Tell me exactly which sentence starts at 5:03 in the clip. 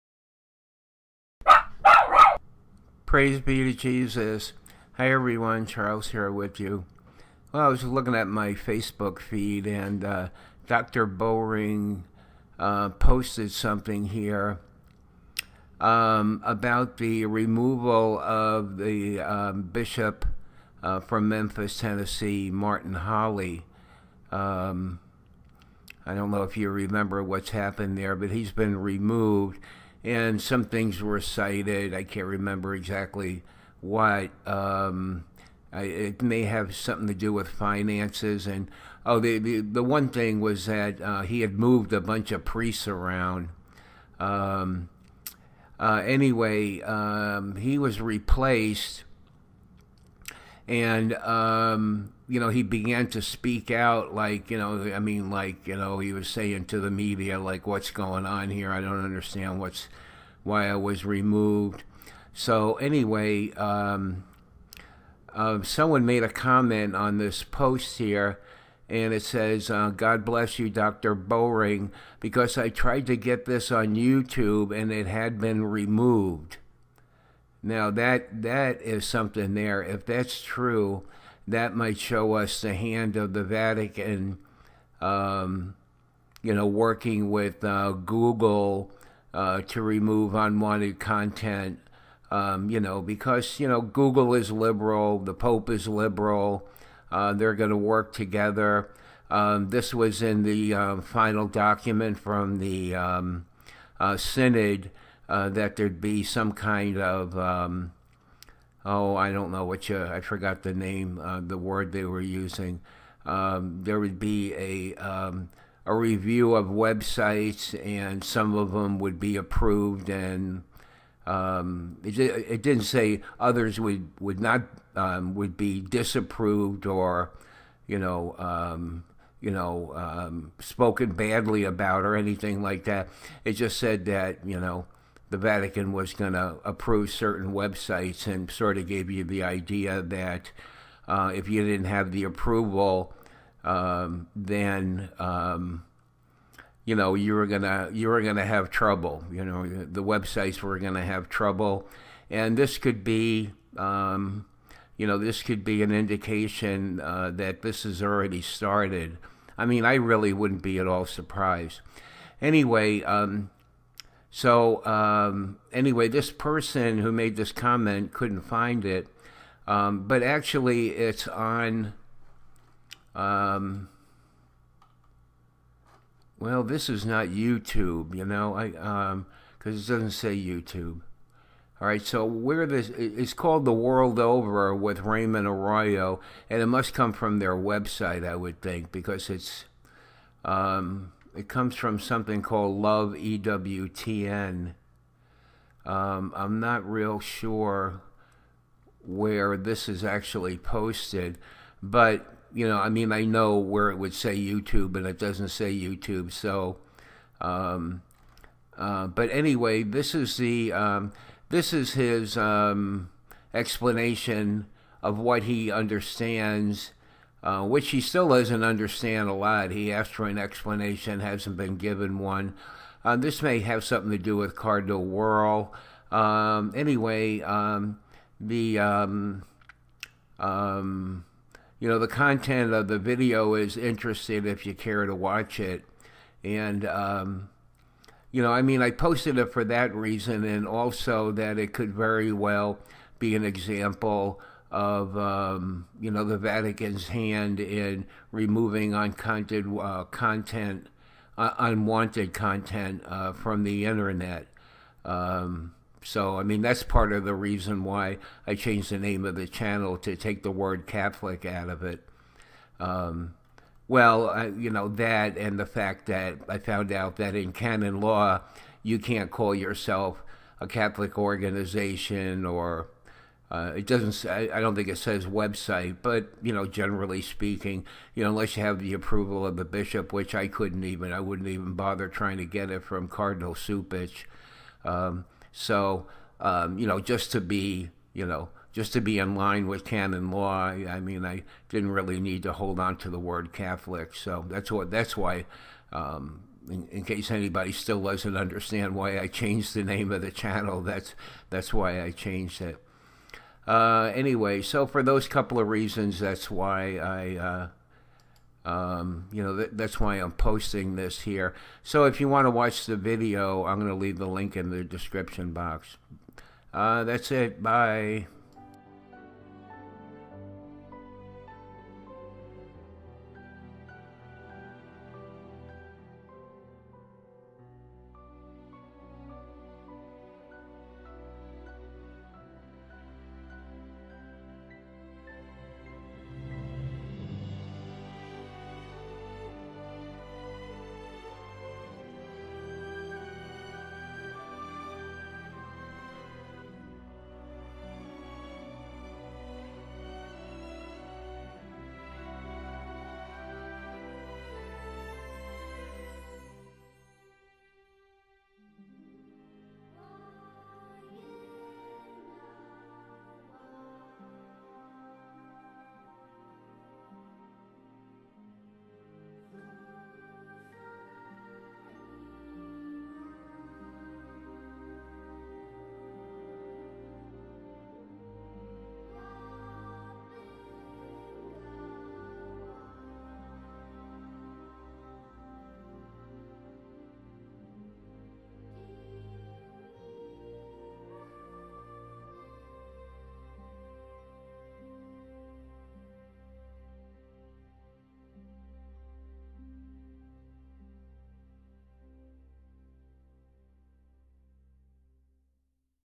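Uh, anyway, so for those couple of reasons, that's why I, uh, um, you know, that's why I'm posting this here.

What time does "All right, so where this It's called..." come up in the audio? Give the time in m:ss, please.
3:01.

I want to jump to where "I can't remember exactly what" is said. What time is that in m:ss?
0:31.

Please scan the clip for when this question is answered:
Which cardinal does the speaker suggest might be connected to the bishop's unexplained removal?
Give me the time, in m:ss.
3:44.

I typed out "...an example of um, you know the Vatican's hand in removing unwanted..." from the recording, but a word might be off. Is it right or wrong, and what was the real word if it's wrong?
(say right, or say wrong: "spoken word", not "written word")
right.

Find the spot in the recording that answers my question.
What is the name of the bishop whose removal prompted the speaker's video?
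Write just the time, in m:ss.
0:22.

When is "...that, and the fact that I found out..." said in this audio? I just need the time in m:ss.
4:24.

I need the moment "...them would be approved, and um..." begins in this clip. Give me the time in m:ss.
1:58.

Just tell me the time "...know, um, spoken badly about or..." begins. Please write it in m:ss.
2:09.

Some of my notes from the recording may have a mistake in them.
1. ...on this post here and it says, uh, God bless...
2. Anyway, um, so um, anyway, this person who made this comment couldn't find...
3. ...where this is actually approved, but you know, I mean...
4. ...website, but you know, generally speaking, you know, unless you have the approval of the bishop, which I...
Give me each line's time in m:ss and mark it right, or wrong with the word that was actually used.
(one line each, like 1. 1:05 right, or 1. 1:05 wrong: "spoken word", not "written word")
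1. 1:06 right
2. 2:42 right
3. 3:19 wrong: "posted", not "approved"
4. 4:35 right.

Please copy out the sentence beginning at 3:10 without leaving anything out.
Um, it comes from something called Love EWTN.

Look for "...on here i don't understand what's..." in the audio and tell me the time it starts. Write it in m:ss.
0:58.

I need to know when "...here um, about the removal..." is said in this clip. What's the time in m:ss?
0:14.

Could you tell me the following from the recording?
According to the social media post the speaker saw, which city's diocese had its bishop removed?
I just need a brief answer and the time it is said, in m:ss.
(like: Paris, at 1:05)
Memphis, Tennessee, at 0:21.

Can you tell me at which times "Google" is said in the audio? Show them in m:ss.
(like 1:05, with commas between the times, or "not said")
1:27, 1:33.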